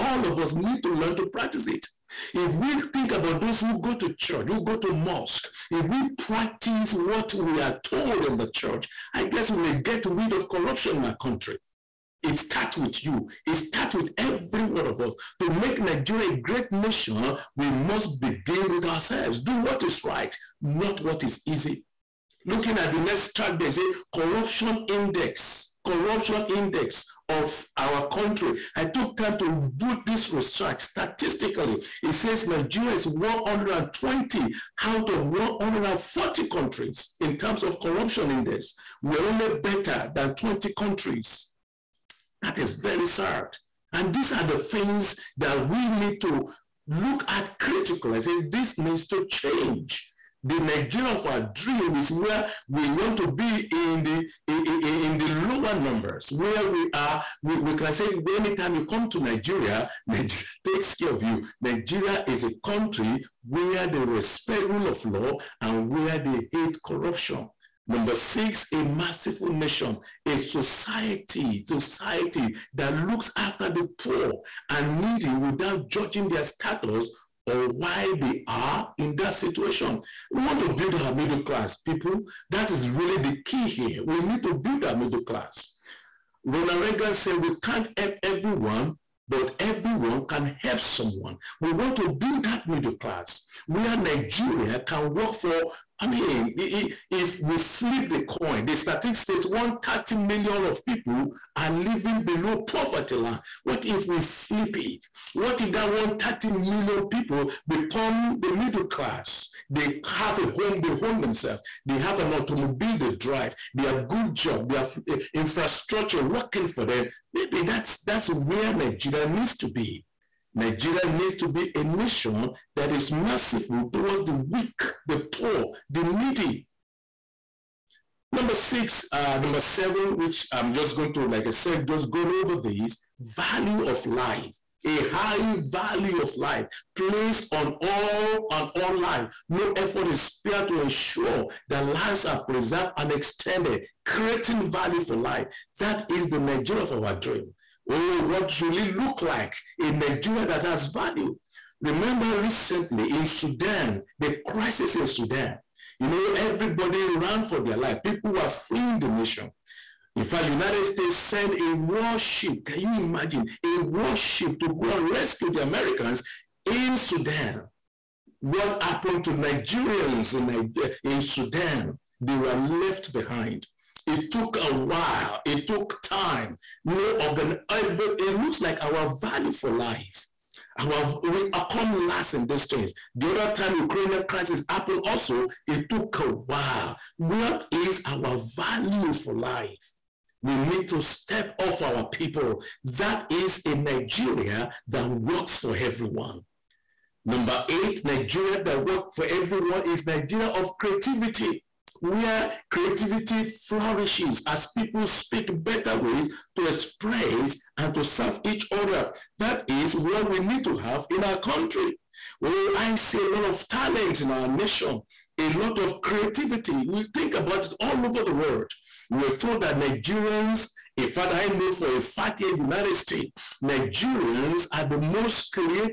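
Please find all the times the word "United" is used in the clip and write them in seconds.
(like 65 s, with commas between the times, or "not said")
160 s, 222 s.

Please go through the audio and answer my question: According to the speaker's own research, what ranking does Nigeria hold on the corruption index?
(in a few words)
120 out of 140.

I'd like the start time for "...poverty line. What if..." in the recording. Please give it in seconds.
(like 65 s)
102 s.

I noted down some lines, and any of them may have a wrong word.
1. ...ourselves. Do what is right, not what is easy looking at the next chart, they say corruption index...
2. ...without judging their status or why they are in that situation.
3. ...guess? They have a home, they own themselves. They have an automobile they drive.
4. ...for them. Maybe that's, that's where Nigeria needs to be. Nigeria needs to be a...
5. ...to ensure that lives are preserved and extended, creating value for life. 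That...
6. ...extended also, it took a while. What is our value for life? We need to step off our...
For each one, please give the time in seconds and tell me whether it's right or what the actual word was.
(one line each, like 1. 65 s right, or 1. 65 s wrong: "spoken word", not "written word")
1. 18 s right
2. 75 s right
3. 108 s wrong: "class", not "guess"
4. 116 s right
5. 140 s right
6. 184 s wrong: "happened", not "extended".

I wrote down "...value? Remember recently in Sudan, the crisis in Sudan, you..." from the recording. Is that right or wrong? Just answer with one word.
right.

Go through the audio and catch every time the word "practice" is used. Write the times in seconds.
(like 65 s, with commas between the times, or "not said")
1 s, 6 s.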